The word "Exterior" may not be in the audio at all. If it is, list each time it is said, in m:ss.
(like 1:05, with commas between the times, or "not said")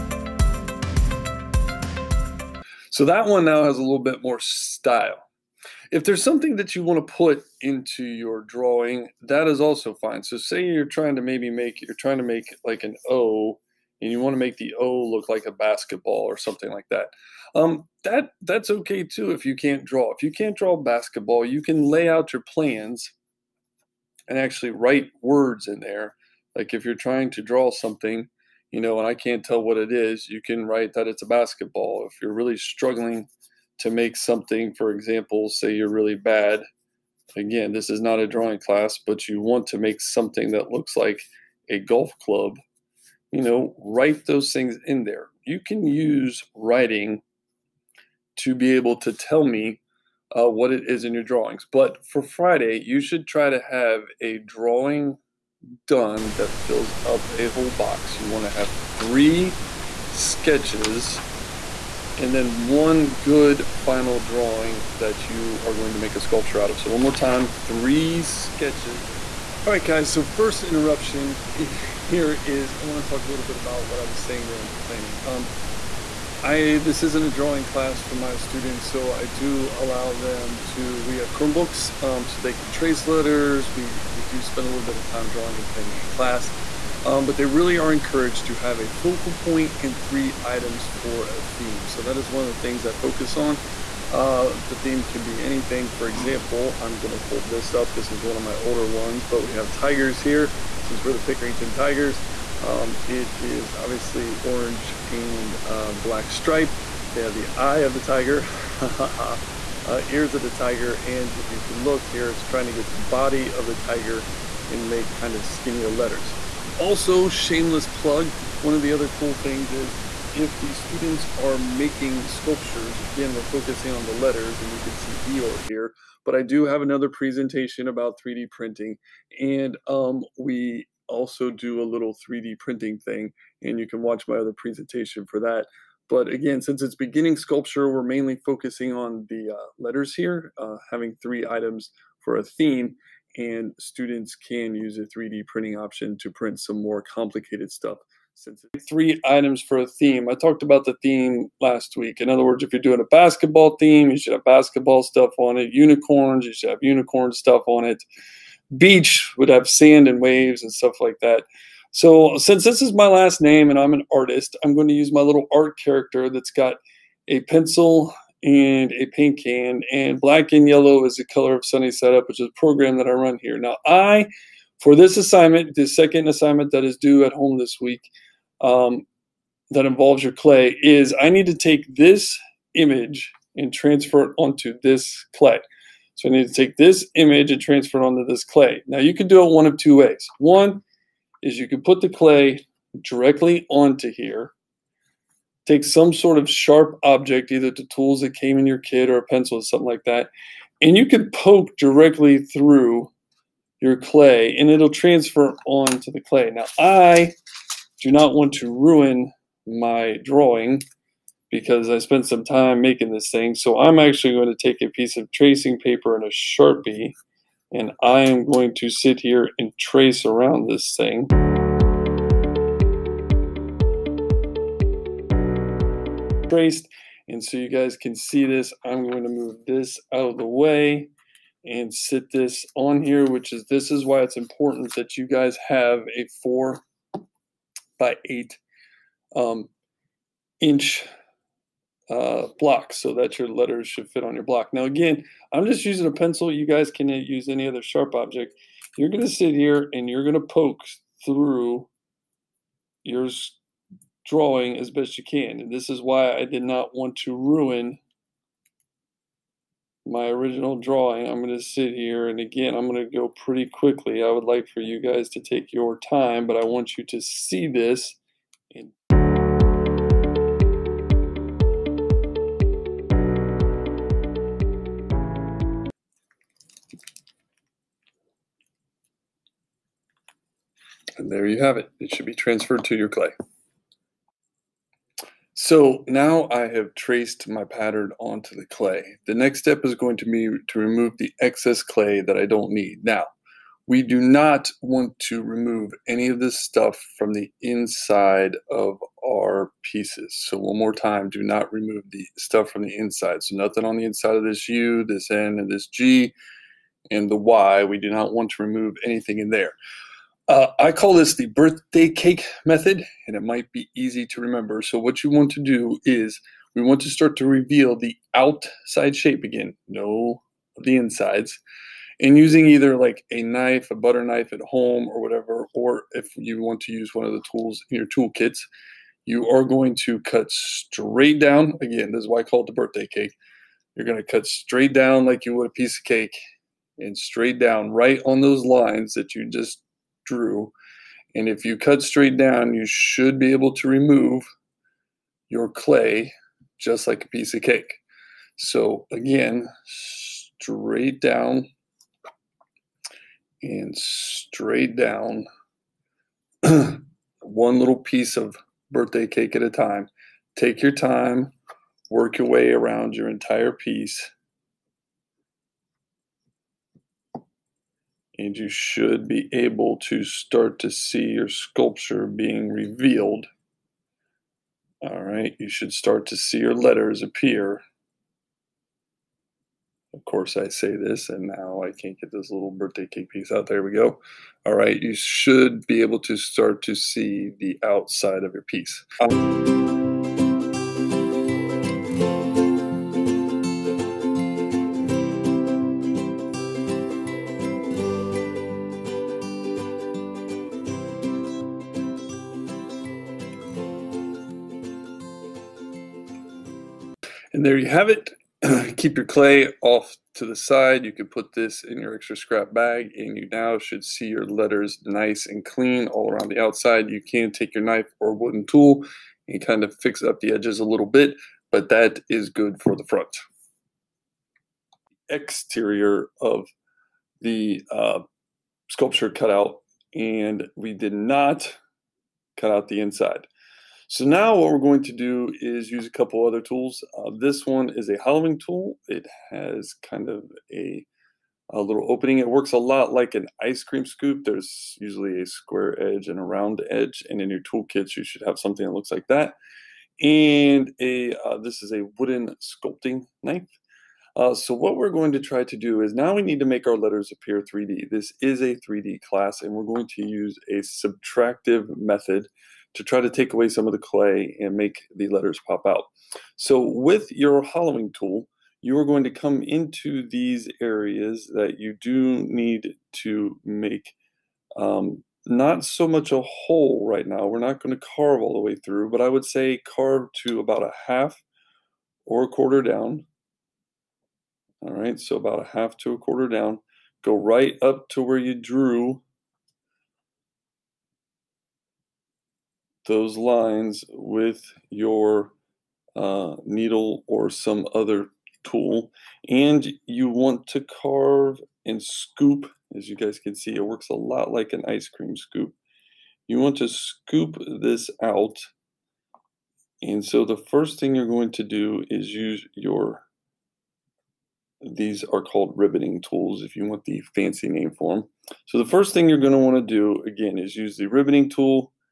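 7:05.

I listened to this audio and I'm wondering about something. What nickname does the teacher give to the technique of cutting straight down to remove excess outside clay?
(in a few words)
birthday cake method.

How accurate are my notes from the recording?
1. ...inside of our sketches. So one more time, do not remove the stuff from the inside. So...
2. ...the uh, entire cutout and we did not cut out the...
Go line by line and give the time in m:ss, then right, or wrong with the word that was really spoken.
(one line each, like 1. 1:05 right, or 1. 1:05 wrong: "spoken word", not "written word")
1. 4:57 wrong: "pieces", not "sketches"
2. 7:07 wrong: "sculpture", not "entire".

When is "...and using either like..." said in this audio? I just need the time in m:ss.
5:22.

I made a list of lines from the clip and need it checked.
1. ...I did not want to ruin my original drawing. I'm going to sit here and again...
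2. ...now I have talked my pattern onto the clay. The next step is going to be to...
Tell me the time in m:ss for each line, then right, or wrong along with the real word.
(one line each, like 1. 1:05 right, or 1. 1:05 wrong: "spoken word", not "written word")
1. 4:16 right
2. 4:46 wrong: "traced", not "talked".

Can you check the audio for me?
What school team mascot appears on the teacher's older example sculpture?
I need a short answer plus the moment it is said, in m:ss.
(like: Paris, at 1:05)
Pickerington Tigers, at 1:41.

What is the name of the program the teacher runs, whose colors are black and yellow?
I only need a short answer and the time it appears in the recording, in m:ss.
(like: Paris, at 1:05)
Sunny Setup, at 2:51.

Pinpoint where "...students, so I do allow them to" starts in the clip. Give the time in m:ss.
1:18.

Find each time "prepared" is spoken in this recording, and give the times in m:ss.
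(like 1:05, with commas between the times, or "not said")
not said.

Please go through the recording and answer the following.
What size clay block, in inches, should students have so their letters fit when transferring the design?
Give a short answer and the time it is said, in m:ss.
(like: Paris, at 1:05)
4 by 8 inches, at 3:56.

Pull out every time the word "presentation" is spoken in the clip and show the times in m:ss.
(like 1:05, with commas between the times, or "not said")
2:07, 2:14.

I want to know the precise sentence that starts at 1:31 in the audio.
So that is one of the things I focus on.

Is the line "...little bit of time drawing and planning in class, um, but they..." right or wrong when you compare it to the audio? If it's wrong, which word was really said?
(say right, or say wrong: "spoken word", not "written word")
right.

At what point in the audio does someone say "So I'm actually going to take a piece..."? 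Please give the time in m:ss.
3:33.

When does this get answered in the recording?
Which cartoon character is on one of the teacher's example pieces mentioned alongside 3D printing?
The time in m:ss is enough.
2:05.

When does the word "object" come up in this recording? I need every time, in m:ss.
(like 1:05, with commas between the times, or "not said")
3:17, 4:08.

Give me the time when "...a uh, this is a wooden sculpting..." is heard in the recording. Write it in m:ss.
7:31.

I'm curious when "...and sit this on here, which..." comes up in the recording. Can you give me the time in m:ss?
3:51.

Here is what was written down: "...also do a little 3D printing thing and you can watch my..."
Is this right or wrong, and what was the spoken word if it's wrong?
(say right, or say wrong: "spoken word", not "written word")
right.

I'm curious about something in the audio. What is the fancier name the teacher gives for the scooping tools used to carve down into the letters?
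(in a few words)
ribboning tools.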